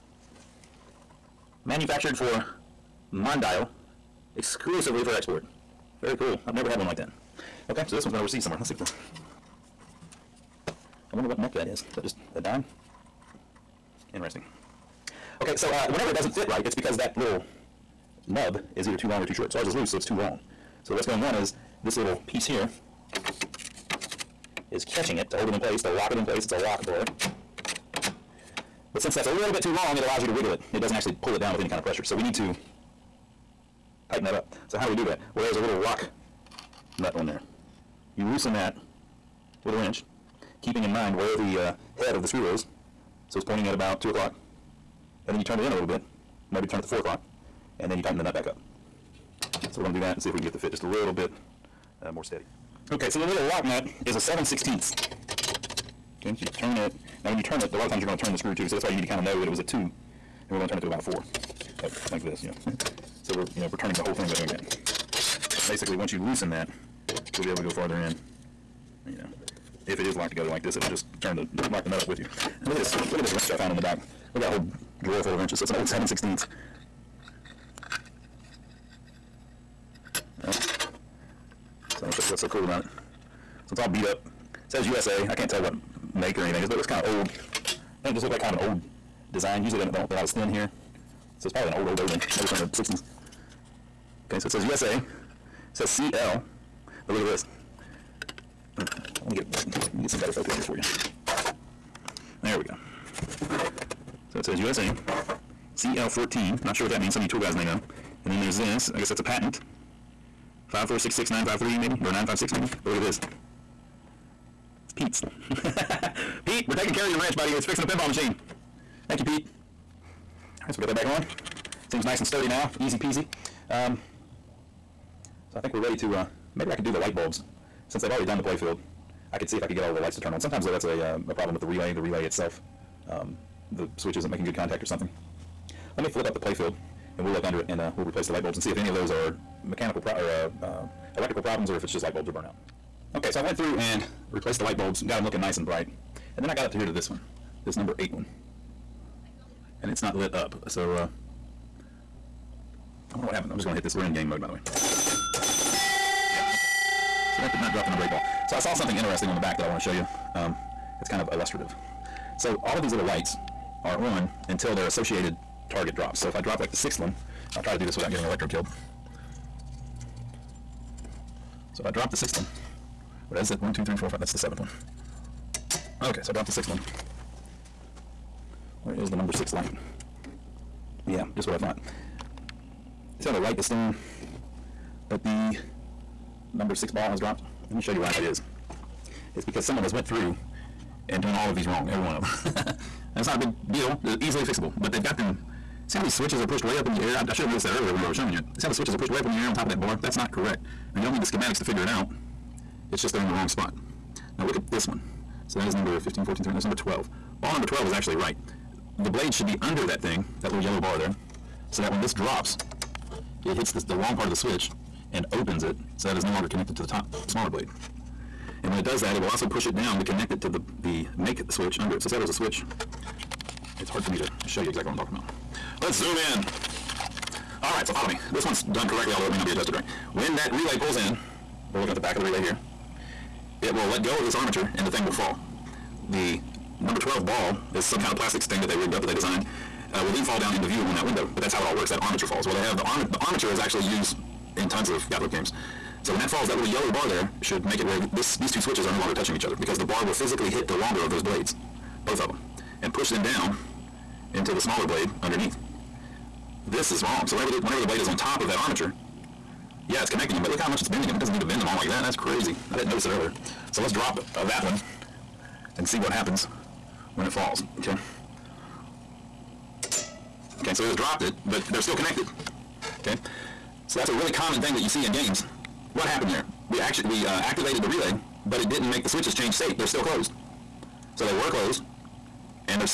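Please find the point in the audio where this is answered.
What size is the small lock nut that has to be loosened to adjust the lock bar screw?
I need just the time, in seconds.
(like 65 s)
54 s.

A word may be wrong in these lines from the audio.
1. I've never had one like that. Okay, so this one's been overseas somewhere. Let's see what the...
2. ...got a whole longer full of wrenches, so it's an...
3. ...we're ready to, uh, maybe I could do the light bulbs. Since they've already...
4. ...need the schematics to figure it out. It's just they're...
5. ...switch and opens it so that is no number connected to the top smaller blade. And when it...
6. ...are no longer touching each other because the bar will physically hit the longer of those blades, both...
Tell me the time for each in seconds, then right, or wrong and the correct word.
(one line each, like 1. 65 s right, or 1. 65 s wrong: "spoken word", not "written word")
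1. 6 s right
2. 74 s wrong: "drawer", not "longer"
3. 125 s right
4. 201 s right
5. 214 s wrong: "longer", not "number"
6. 248 s right.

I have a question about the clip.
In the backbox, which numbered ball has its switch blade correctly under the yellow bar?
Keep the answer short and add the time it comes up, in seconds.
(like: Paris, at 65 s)
12, at 207 s.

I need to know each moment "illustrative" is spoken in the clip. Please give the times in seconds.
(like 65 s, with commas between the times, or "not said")
161 s.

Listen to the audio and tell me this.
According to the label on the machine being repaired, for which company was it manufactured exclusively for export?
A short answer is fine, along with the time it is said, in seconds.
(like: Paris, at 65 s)
Mondial, at 3 s.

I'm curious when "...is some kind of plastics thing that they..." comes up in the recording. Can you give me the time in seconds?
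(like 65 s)
237 s.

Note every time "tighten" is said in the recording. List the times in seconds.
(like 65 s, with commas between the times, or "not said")
34 s, 48 s.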